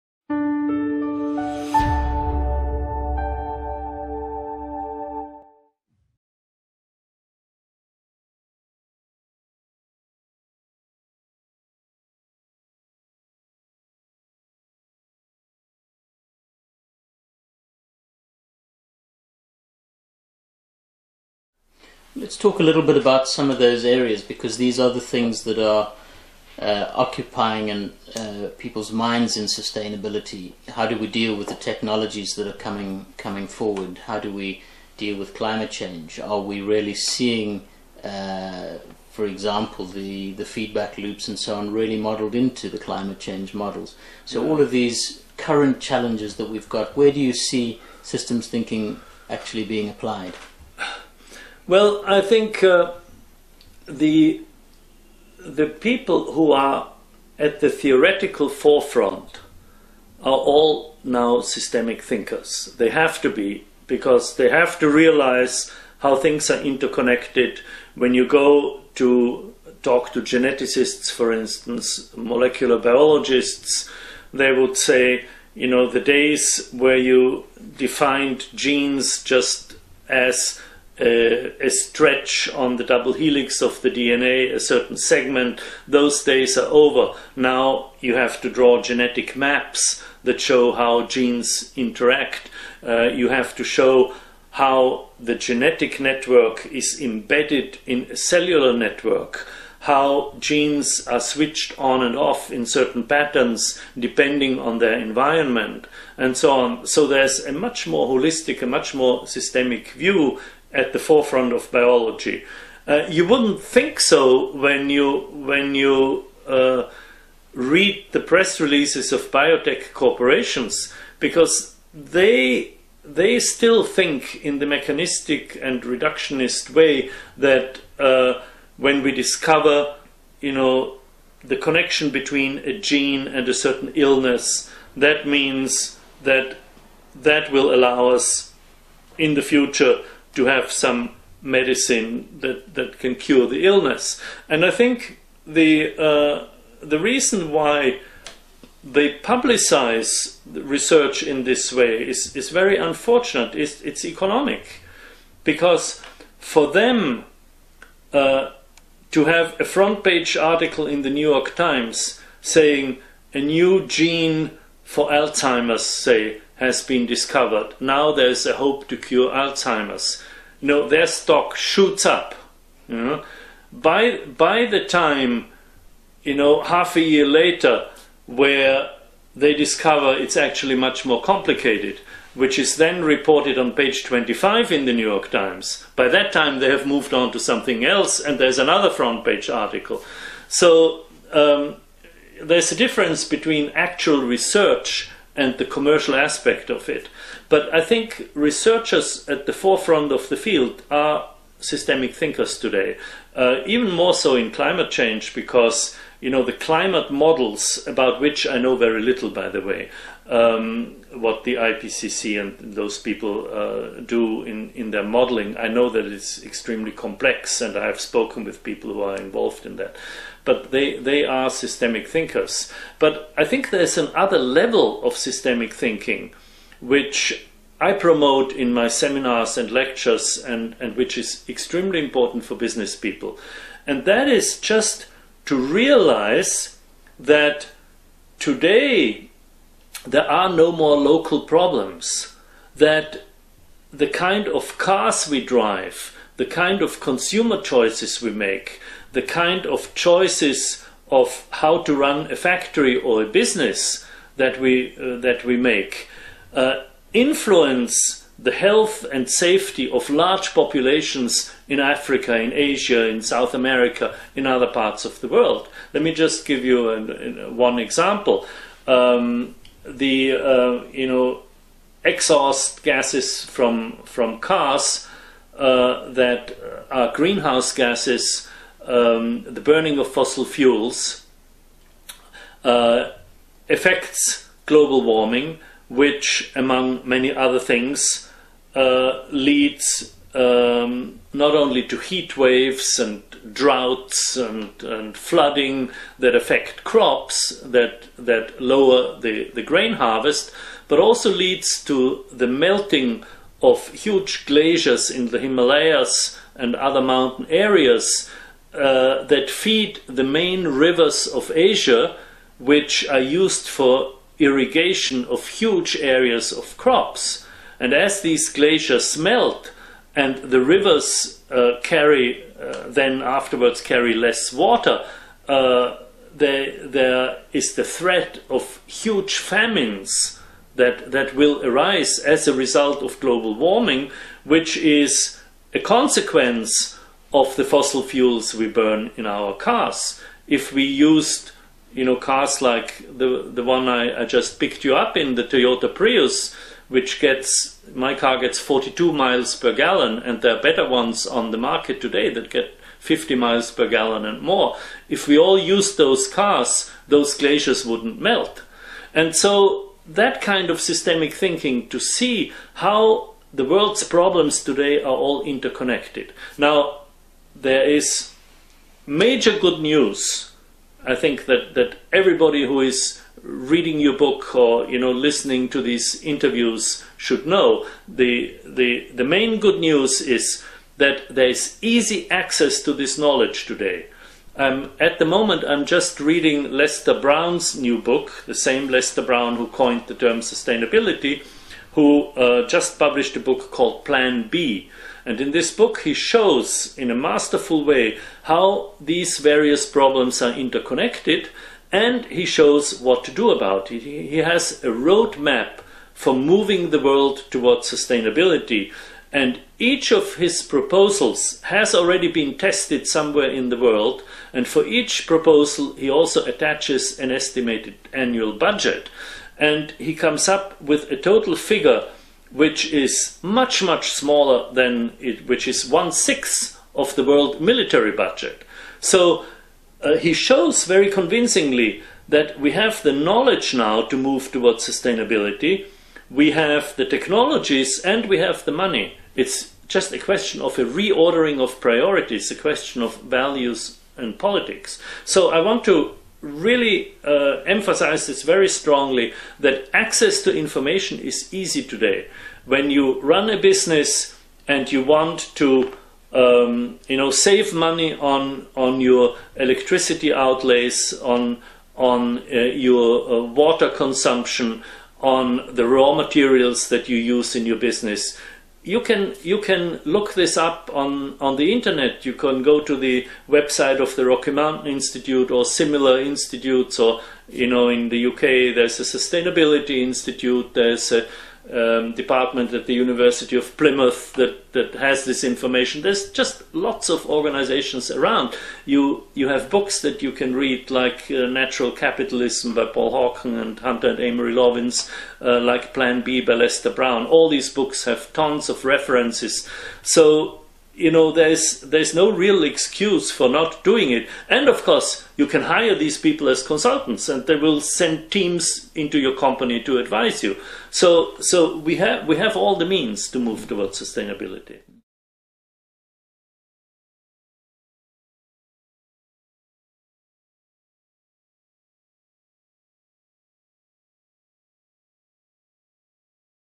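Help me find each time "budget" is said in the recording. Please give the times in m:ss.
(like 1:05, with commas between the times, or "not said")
6:58, 7:08.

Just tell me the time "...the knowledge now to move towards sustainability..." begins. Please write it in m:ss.
7:13.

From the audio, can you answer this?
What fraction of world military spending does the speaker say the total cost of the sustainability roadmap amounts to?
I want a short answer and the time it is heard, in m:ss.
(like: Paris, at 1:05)
one sixth, at 7:05.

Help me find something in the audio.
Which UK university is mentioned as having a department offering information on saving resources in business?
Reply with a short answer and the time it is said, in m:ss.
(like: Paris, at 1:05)
University of Plymouth, at 8:02.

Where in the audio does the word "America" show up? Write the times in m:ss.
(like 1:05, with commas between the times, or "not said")
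4:23.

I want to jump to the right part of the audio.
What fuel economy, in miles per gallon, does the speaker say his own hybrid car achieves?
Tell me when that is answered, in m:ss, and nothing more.
5:48.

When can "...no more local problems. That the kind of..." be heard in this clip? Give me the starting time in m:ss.
4:00.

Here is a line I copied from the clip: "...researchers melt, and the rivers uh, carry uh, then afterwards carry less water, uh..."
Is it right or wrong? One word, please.
wrong.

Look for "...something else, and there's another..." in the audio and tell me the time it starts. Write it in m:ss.
3:07.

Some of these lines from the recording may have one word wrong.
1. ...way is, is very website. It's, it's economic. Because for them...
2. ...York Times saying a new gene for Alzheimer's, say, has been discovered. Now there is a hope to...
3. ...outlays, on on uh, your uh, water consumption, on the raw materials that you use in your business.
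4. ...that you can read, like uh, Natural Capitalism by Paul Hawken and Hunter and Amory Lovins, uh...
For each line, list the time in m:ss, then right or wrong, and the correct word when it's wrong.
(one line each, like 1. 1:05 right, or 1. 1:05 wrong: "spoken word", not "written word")
1. 2:31 wrong: "unfortunate", not "website"
2. 2:41 right
3. 7:40 right
4. 8:10 right.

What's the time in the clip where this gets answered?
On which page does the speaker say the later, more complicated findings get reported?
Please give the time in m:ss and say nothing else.
3:03.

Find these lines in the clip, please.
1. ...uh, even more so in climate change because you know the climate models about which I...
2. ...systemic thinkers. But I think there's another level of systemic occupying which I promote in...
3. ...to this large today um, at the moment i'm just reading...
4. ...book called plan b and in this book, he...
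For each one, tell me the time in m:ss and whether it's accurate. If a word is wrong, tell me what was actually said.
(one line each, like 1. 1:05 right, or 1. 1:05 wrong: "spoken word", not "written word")
1. 3:23 right
2. 3:41 wrong: "thinking", not "occupying"
3. 6:22 wrong: "knowledge", not "large"
4. 6:33 right.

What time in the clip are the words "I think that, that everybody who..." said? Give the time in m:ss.
6:11.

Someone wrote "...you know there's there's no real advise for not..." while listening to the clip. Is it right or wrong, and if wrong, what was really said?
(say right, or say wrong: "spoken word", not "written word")
wrong: "excuse", not "advise".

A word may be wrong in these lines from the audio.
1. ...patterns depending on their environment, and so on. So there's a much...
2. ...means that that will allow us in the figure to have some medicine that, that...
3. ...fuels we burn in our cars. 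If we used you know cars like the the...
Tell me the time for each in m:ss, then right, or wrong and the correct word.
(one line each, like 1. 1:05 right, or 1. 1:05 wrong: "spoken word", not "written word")
1. 1:43 right
2. 2:15 wrong: "future", not "figure"
3. 5:38 right.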